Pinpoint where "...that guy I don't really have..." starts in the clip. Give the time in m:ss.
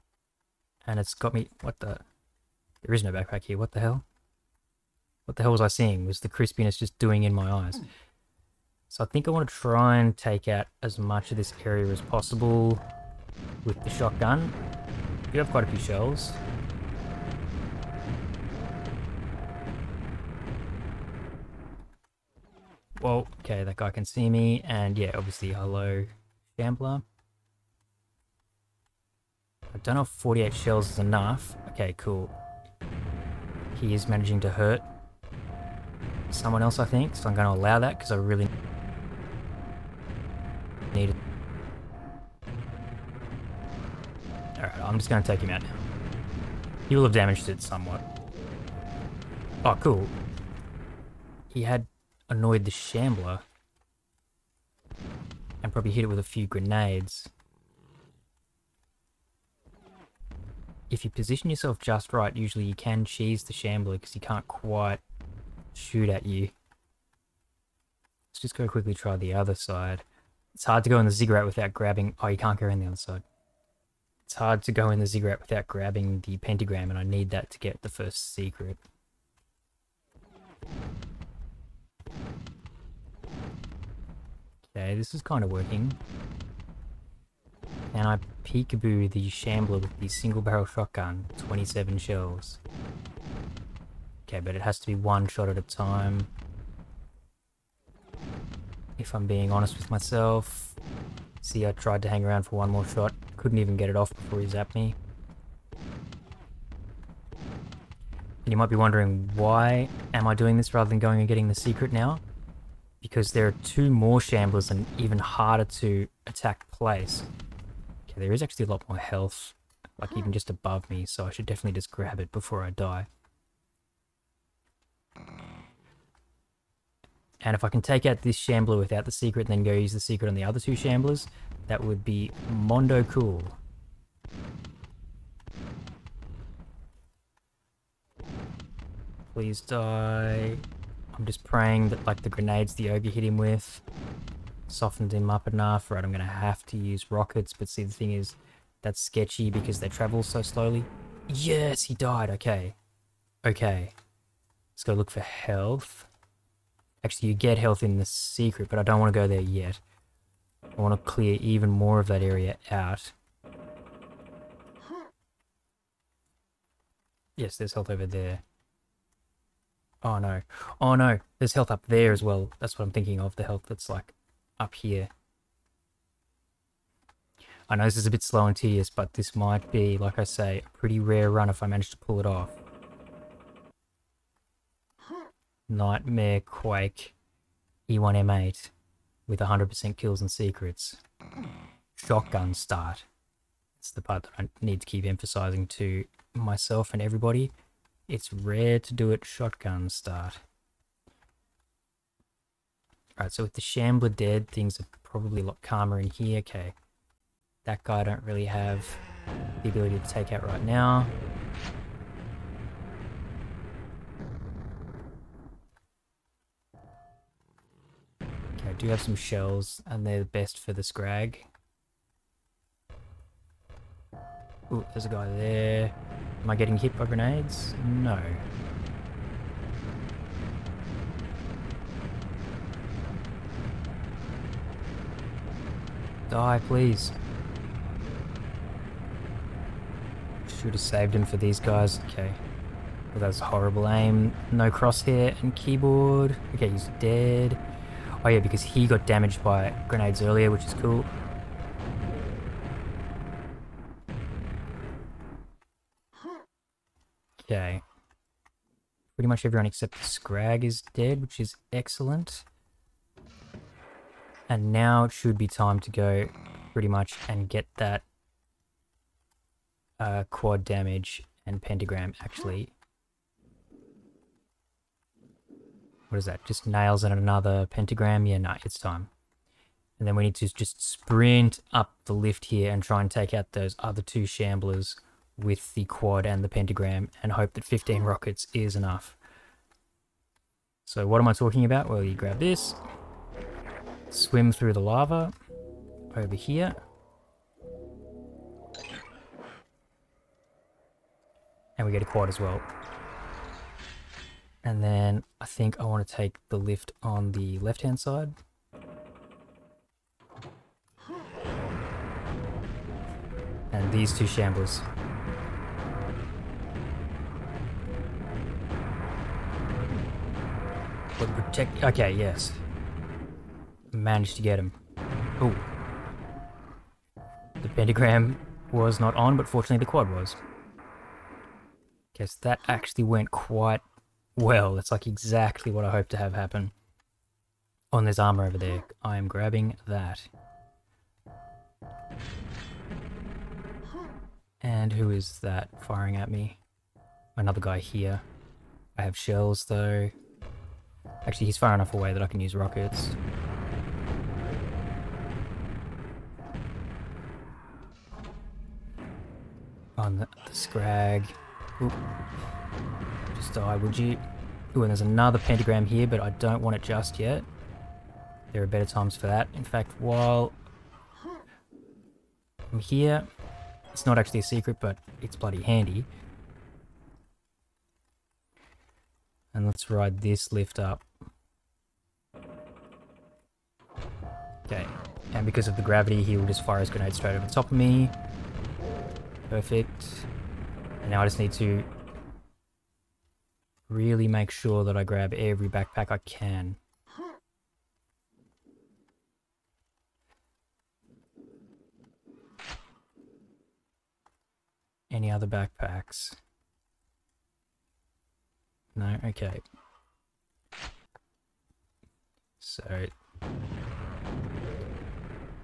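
3:27.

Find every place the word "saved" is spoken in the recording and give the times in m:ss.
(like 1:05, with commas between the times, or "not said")
4:00.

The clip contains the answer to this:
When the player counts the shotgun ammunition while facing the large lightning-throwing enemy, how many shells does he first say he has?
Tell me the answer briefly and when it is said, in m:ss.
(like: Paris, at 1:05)
48, at 0:30.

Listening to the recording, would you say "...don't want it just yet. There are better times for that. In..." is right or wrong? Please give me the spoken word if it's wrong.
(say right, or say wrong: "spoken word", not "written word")
right.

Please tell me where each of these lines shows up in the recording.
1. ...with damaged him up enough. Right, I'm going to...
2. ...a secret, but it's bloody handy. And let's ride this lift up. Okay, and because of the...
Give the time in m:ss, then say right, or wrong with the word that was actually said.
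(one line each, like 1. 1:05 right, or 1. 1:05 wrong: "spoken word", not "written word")
1. 2:23 wrong: "softened", not "damaged"
2. 6:14 right.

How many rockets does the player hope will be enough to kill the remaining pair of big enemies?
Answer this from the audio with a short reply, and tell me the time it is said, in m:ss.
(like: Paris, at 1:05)
15, at 4:47.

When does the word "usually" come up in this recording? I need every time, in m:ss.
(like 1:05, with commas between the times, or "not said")
1:02.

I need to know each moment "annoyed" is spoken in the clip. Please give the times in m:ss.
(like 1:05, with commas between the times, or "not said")
0:52.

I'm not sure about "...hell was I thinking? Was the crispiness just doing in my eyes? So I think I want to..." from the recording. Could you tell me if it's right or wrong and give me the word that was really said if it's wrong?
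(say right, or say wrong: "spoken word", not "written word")
wrong: "seeing", not "thinking".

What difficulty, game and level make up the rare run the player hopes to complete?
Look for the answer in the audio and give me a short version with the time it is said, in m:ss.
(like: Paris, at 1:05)
Nightmare Quake E1M8, at 3:05.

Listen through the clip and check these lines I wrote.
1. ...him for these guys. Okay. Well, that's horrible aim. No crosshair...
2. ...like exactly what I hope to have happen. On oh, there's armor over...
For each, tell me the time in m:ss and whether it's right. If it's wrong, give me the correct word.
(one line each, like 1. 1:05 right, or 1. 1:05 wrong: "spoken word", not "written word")
1. 4:01 right
2. 5:34 right.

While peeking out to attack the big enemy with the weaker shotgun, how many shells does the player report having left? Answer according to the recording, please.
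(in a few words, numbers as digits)
27.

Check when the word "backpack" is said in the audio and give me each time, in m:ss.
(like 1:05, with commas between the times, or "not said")
0:03, 6:35, 6:45.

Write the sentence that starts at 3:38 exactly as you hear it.
do have some shells, and they're the best for the scrag.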